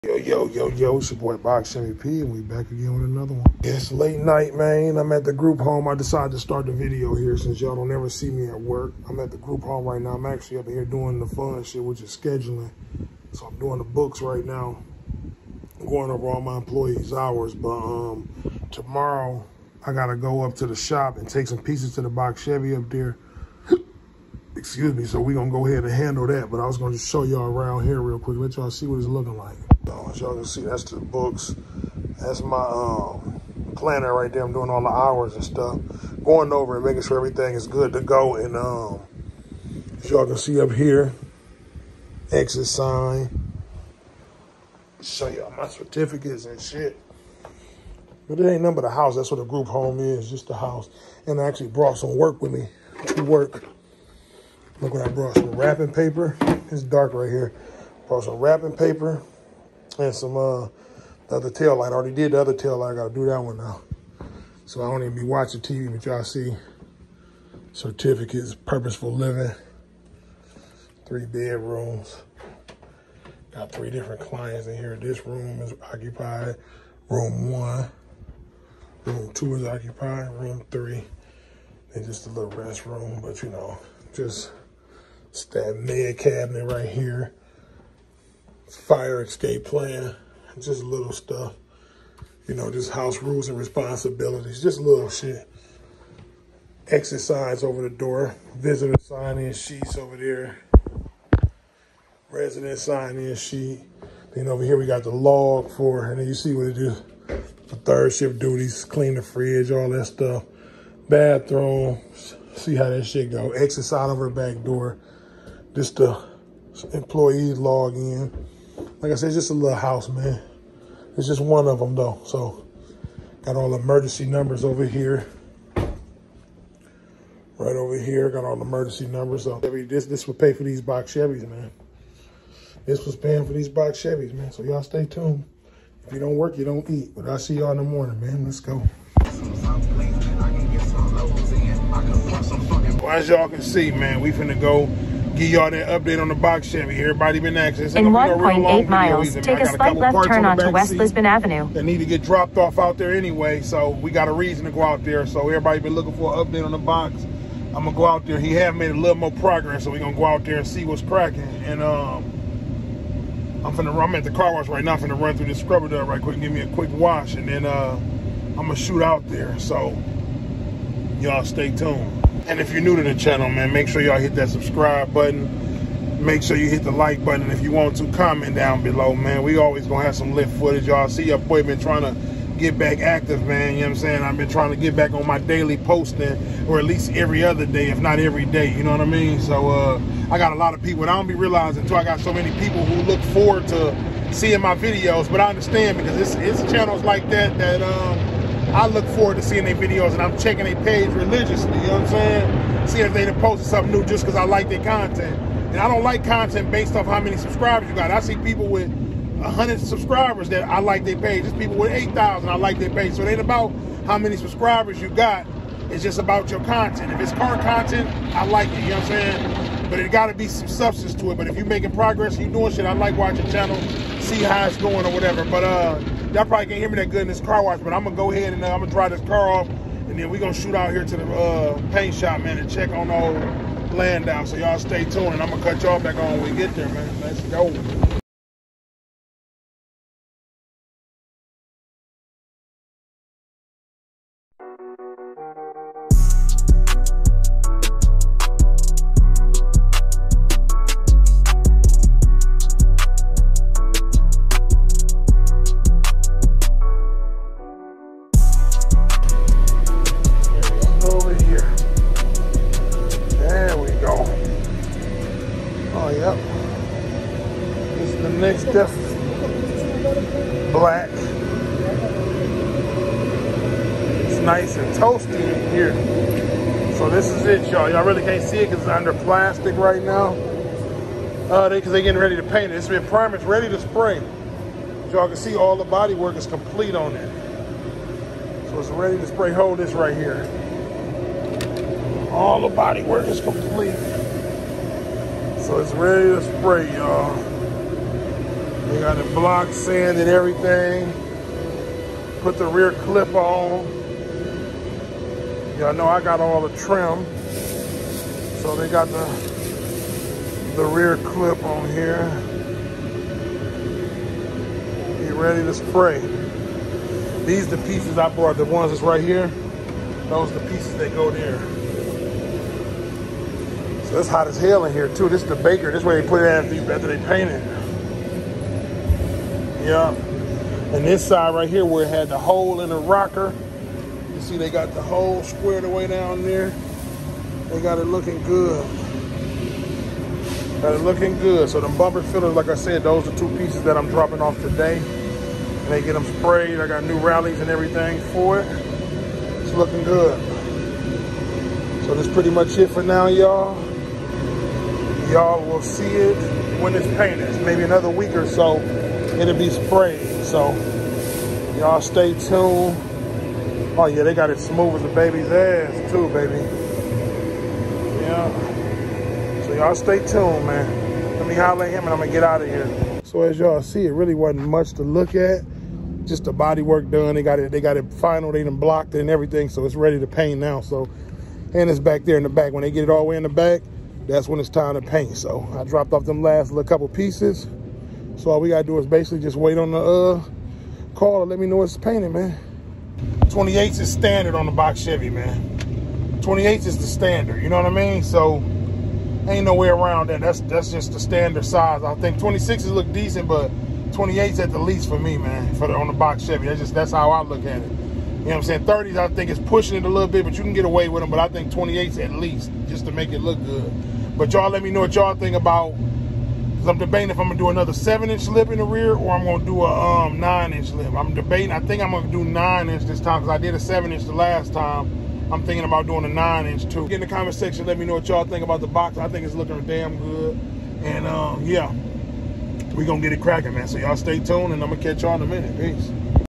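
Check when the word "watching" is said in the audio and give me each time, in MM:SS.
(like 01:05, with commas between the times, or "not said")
01:05, 03:43.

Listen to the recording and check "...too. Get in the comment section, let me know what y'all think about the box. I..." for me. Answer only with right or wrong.
right.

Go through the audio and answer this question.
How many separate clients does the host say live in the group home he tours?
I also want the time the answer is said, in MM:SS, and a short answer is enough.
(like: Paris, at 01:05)
3, at 01:13.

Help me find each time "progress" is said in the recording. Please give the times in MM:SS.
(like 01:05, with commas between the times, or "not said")
02:39, 03:41.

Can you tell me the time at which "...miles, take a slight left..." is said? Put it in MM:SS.
02:28.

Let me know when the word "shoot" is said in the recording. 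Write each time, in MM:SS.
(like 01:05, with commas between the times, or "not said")
02:48, 03:50.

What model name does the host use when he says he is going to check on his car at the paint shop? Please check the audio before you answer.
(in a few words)
Landau.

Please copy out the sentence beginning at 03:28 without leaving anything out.
I see people with 100 subscribers that I like their page.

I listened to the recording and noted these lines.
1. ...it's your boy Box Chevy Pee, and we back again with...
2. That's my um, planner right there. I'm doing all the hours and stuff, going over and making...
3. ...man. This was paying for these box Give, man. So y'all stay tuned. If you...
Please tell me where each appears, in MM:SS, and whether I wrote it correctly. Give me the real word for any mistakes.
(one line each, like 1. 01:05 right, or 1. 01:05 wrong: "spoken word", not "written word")
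1. 00:00 right
2. 00:32 right
3. 02:11 wrong: "Chevys", not "Give".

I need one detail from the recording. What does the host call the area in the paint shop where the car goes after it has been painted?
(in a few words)
The baker.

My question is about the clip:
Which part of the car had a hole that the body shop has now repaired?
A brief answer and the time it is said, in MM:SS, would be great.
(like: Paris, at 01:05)
The rocker, at 05:32.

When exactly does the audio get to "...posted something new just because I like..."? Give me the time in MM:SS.
03:23.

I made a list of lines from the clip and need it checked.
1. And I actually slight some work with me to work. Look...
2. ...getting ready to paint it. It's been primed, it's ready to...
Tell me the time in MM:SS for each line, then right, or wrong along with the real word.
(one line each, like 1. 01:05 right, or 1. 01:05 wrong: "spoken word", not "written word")
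1. 00:51 wrong: "brought", not "slight"
2. 04:42 right.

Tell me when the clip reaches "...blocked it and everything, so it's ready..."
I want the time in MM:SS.
06:18.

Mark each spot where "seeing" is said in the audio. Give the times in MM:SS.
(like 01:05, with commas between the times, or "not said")
03:14, 03:19.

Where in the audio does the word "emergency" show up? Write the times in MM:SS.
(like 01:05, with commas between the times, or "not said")
02:03, 02:08.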